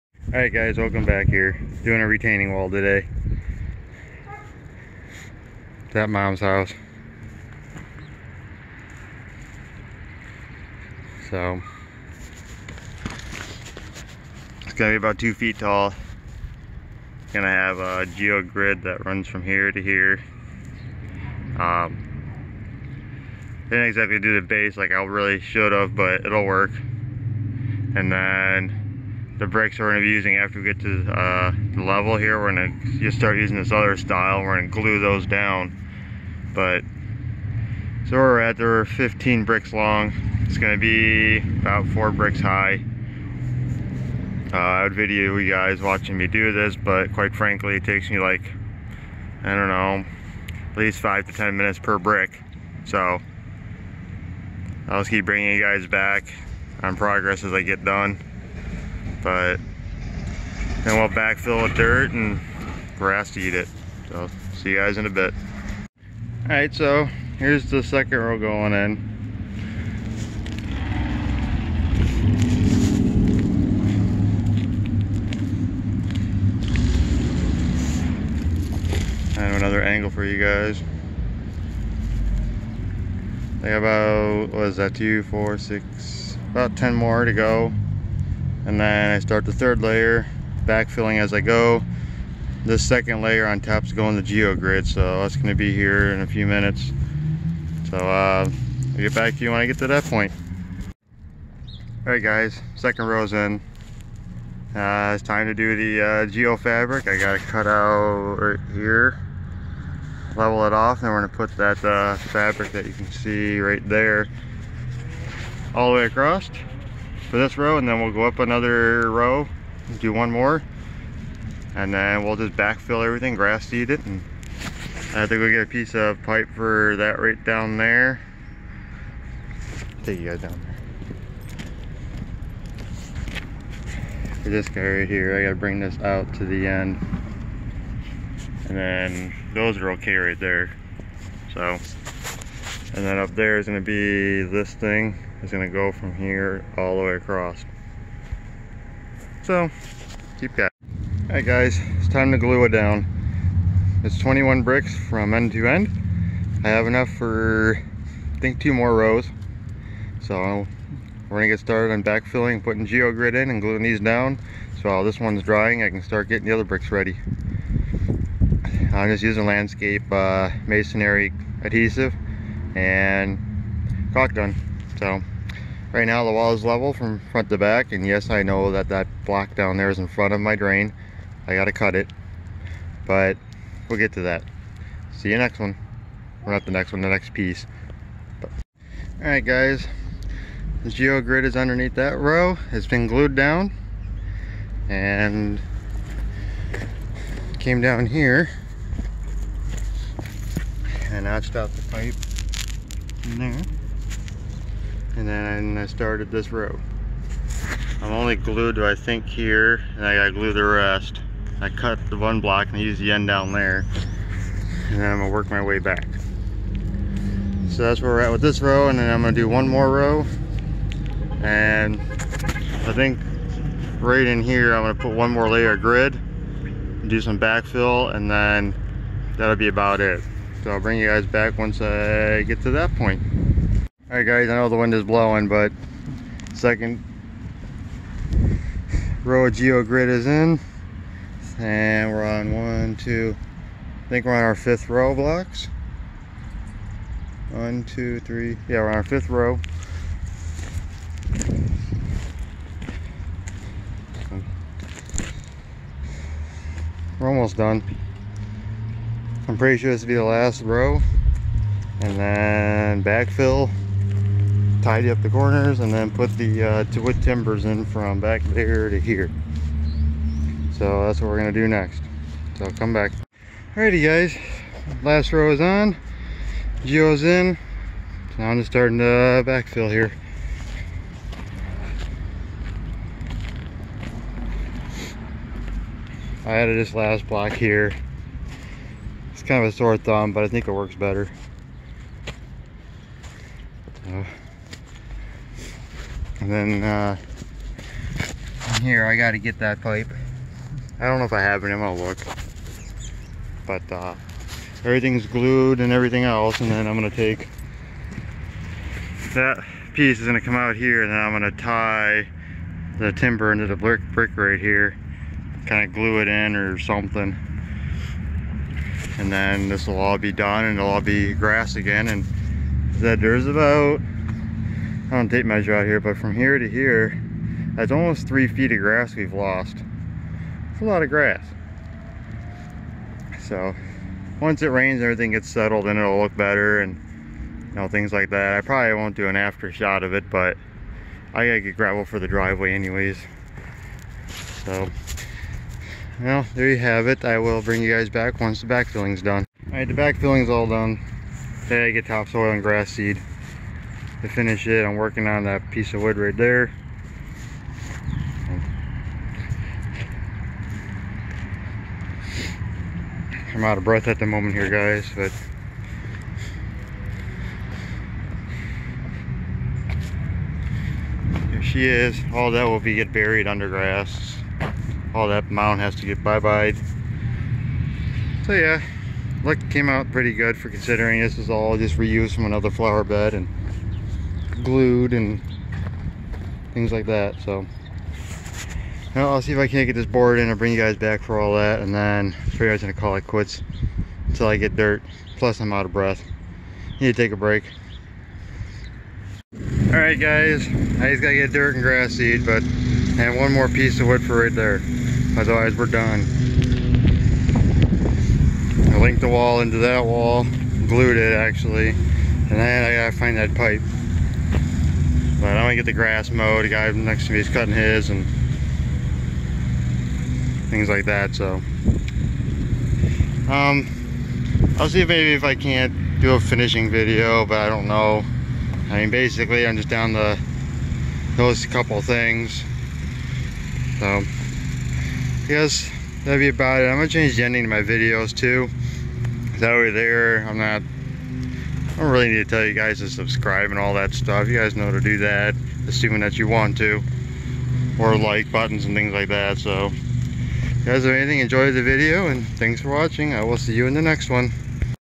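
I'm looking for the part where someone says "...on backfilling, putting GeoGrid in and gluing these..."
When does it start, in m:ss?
2:41.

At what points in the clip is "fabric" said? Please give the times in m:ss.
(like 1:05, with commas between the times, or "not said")
1:46, 1:52.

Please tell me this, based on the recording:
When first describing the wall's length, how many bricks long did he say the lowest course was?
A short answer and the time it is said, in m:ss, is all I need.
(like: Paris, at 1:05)
15, at 0:38.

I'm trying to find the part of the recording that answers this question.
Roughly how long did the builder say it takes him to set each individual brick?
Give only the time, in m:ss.
0:50.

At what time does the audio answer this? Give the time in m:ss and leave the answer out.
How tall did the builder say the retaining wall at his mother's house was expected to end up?
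0:15.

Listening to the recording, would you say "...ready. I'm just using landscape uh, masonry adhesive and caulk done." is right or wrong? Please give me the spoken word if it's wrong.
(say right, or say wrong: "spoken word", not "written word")
right.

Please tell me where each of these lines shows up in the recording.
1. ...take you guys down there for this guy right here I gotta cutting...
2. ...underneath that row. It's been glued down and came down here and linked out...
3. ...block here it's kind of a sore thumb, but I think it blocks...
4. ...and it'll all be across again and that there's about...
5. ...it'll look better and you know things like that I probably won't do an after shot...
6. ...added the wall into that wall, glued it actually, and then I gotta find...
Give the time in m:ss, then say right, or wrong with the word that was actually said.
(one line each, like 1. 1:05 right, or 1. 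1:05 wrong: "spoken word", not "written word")
1. 2:10 wrong: "bring", not "cutting"
2. 3:11 wrong: "notched", not "linked"
3. 4:47 wrong: "works", not "blocks"
4. 5:20 wrong: "grass", not "across"
5. 5:35 right
6. 6:48 wrong: "linked", not "added".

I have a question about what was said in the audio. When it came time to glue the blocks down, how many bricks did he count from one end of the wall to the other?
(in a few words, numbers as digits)
21.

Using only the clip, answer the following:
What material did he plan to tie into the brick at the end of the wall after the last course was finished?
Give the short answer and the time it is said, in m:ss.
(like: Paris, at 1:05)
Wood timbers, at 4:26.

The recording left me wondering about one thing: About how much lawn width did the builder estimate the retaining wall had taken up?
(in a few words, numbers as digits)
Almost 3 feet.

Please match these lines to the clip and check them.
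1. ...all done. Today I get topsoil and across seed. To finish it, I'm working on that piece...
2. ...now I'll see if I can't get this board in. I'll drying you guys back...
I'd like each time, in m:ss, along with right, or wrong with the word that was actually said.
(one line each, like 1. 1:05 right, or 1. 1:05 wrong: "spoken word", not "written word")
1. 5:50 wrong: "grass", not "across"
2. 6:29 wrong: "bring", not "drying".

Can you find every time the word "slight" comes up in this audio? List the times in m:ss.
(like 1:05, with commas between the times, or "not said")
not said.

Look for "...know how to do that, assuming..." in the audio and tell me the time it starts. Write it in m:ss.
7:24.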